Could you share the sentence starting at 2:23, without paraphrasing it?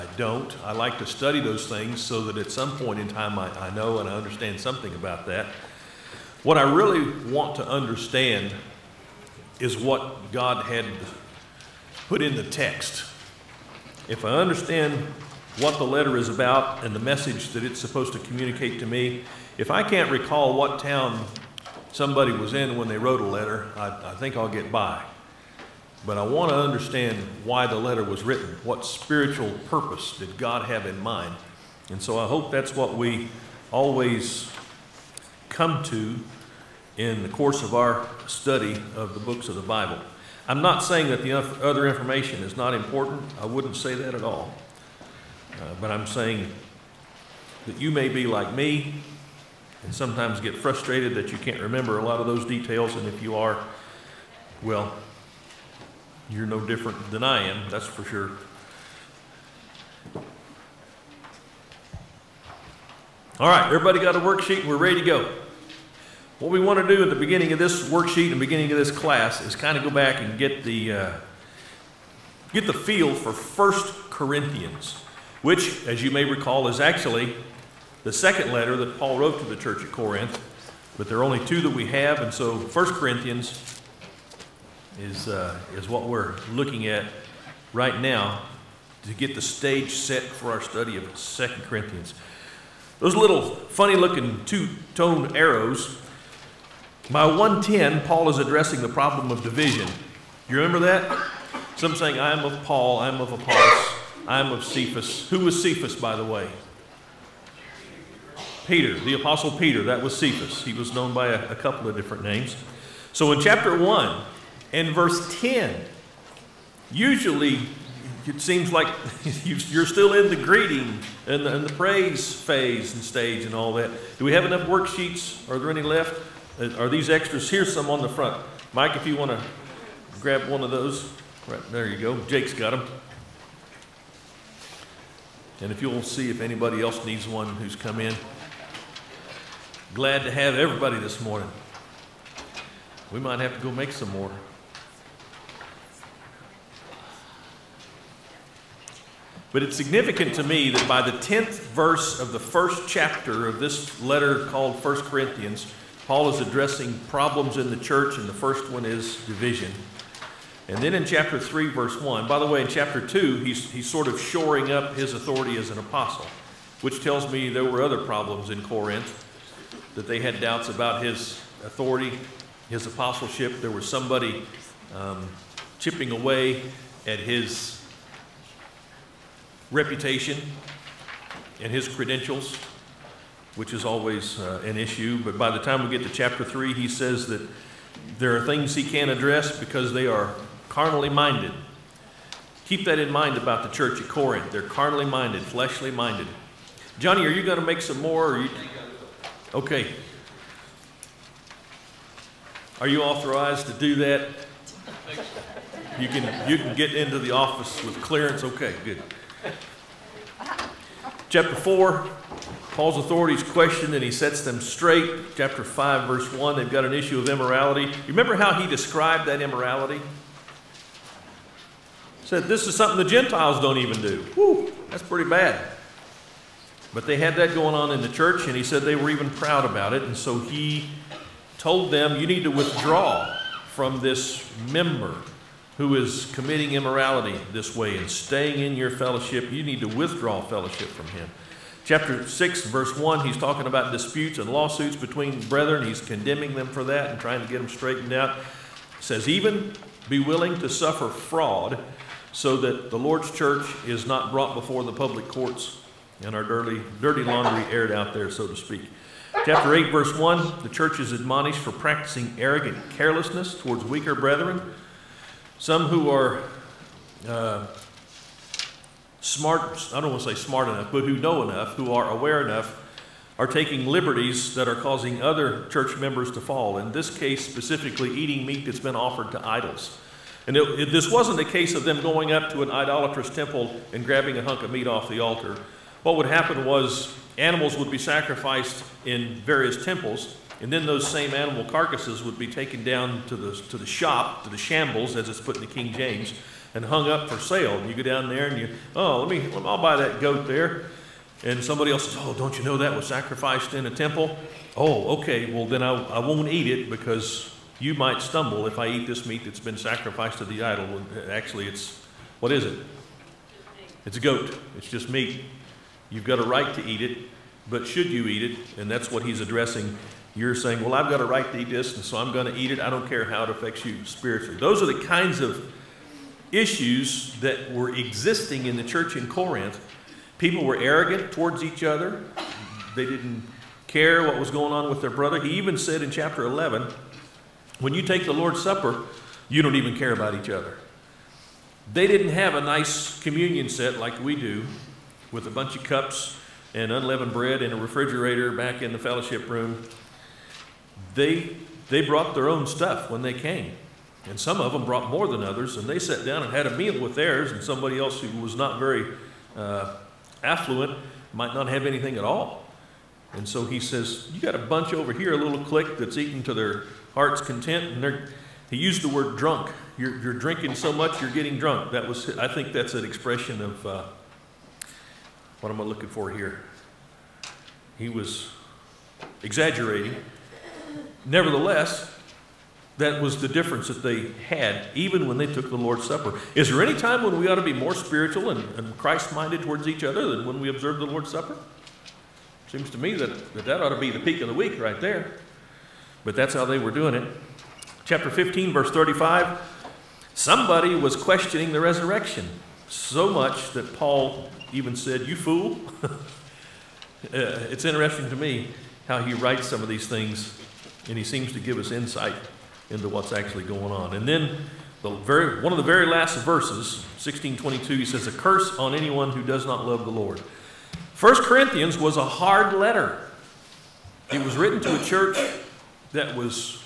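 We might have to go make some more.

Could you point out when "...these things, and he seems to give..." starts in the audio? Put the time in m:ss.
6:49.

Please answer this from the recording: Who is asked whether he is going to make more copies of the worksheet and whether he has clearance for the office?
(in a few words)
Johnny.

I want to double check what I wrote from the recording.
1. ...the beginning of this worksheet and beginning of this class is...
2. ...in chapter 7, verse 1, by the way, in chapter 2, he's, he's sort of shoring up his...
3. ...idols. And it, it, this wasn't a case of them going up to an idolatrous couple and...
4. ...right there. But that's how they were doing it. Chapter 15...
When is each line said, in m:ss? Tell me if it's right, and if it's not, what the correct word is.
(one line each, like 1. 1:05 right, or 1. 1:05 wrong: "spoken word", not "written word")
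1. 1:07 right
2. 2:40 wrong: "3", not "7"
3. 4:39 wrong: "temple", not "couple"
4. 6:34 right.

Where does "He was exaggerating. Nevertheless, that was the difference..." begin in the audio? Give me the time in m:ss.
6:17.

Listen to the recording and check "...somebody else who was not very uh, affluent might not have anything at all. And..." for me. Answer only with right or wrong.
right.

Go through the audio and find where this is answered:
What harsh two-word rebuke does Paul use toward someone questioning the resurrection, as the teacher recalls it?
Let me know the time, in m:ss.
6:45.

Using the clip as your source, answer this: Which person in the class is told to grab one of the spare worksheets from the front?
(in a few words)
Mike.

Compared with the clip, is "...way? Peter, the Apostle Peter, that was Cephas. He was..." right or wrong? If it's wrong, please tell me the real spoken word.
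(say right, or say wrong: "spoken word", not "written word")
right.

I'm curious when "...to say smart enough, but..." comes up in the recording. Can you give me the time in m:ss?
4:30.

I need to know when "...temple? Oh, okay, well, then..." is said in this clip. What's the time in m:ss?
5:03.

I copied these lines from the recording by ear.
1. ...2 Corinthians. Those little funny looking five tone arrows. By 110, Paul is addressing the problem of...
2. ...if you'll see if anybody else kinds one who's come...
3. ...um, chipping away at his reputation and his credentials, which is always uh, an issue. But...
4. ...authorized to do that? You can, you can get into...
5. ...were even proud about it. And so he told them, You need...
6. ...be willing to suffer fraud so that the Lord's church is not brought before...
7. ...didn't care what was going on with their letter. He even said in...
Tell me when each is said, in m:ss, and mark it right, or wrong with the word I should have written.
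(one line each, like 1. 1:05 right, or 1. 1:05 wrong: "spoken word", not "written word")
1. 1:31 wrong: "two", not "five"
2. 2:15 wrong: "needs", not "kinds"
3. 2:54 right
4. 3:23 right
5. 3:48 right
6. 4:10 right
7. 5:33 wrong: "brother", not "letter".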